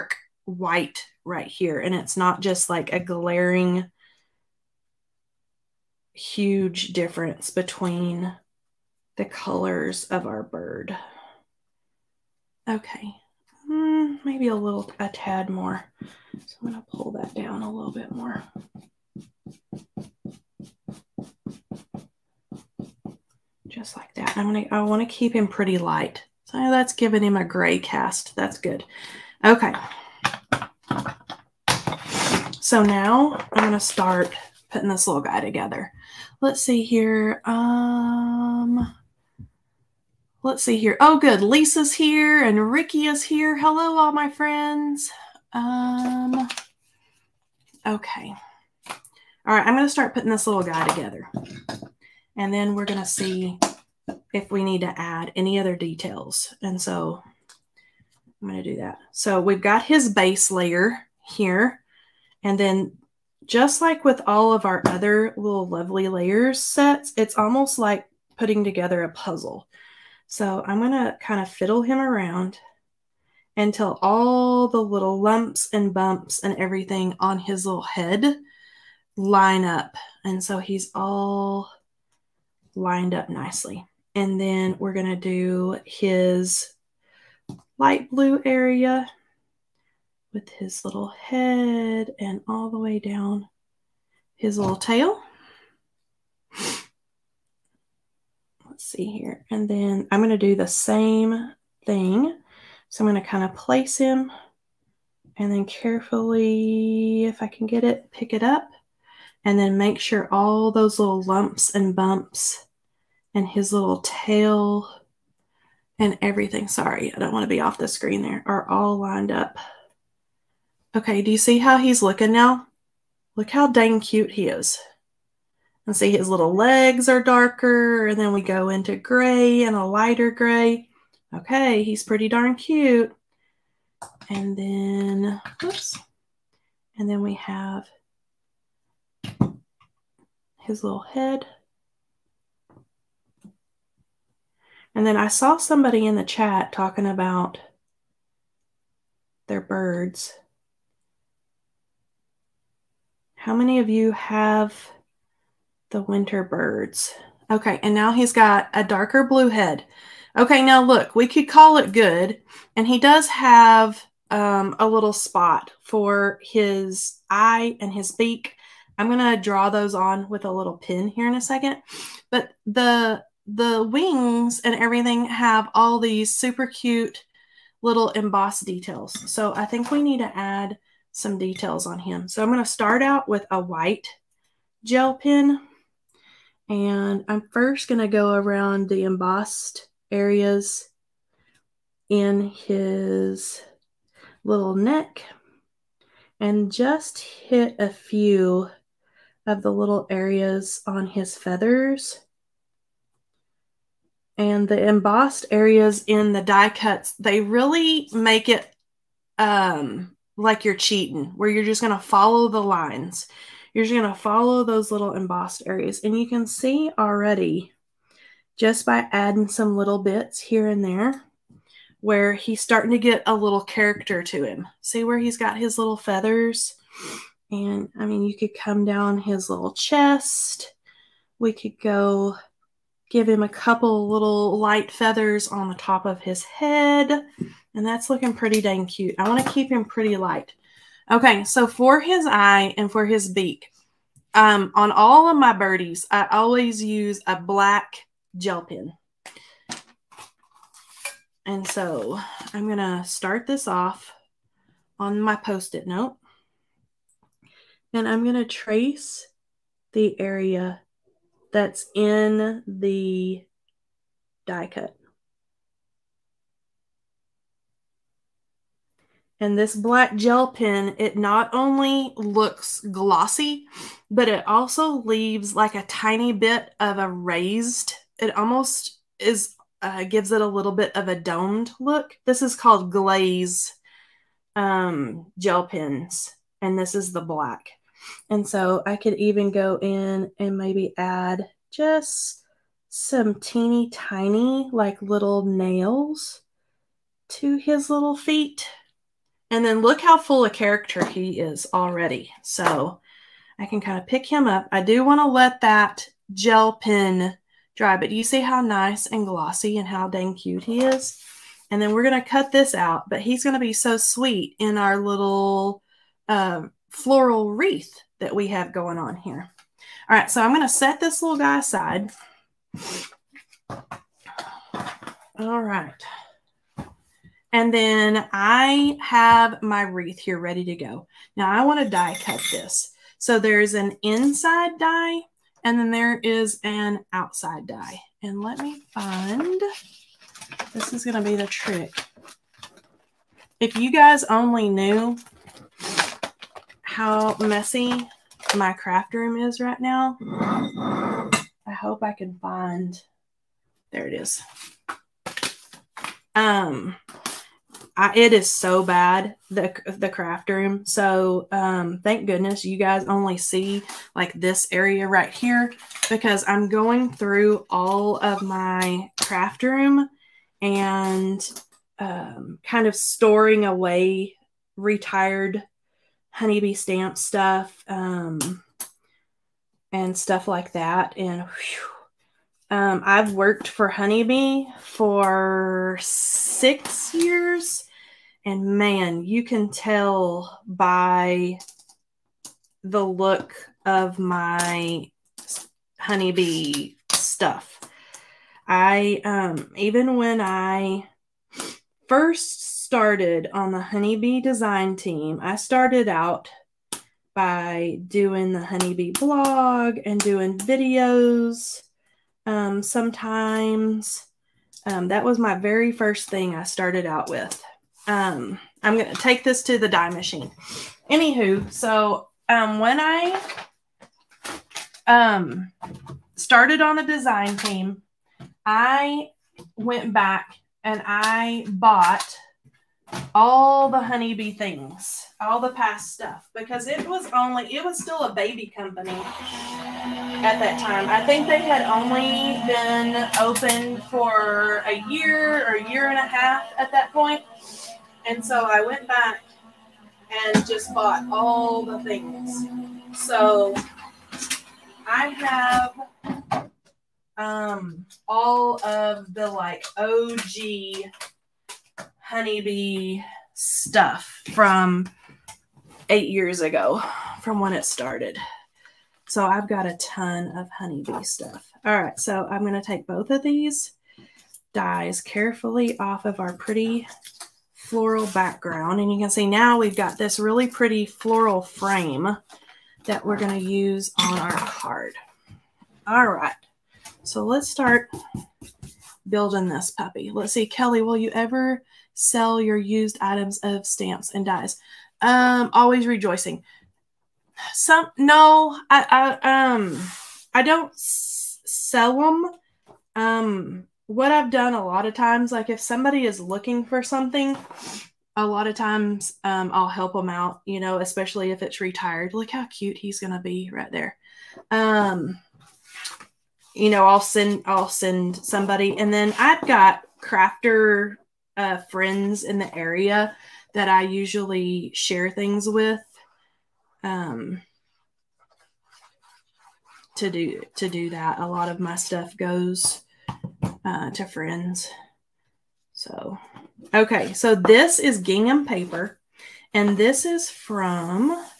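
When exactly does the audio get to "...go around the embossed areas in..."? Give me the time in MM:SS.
03:08.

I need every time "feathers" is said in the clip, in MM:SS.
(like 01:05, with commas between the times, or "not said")
03:21, 03:45, 03:54.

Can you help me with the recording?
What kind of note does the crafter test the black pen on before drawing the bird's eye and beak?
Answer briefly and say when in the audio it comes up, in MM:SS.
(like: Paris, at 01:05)
Post-it note, at 04:15.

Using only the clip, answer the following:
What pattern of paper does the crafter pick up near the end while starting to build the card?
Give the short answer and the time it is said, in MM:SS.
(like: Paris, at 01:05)
Gingham, at 08:58.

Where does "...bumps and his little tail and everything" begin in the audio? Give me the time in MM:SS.
01:51.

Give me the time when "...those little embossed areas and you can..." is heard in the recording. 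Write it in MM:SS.
03:34.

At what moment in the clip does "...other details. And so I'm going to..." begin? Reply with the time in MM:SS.
00:55.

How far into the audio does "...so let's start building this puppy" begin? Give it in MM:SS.
08:07.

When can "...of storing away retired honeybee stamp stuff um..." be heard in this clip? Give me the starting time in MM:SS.
06:12.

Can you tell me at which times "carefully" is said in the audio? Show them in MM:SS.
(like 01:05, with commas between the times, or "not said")
01:45, 07:55.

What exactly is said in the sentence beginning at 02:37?
Okay, and now he's got a darker blue head.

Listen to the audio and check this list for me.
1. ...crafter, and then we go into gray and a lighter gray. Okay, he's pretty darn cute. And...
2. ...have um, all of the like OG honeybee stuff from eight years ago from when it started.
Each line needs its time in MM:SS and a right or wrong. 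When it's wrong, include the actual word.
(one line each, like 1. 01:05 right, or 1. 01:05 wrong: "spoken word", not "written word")
1. 02:07 wrong: "darker", not "crafter"
2. 07:35 right.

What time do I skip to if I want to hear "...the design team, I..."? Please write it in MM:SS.
07:06.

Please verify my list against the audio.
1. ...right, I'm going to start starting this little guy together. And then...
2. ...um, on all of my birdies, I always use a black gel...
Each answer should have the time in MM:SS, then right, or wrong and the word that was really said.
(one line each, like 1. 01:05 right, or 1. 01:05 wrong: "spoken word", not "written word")
1. 00:49 wrong: "putting", not "starting"
2. 04:04 right.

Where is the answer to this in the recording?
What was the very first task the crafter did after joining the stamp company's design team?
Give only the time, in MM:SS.
06:48.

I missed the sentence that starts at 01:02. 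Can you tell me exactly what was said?
And then just like with all of our other little lovely layers sets, it's almost like putting together a puzzle.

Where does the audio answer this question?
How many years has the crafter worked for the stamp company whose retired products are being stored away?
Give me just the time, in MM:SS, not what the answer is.
06:25.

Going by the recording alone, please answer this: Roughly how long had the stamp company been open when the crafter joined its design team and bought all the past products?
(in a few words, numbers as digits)
A year or a year and a half.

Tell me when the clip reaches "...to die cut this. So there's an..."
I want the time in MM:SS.
05:31.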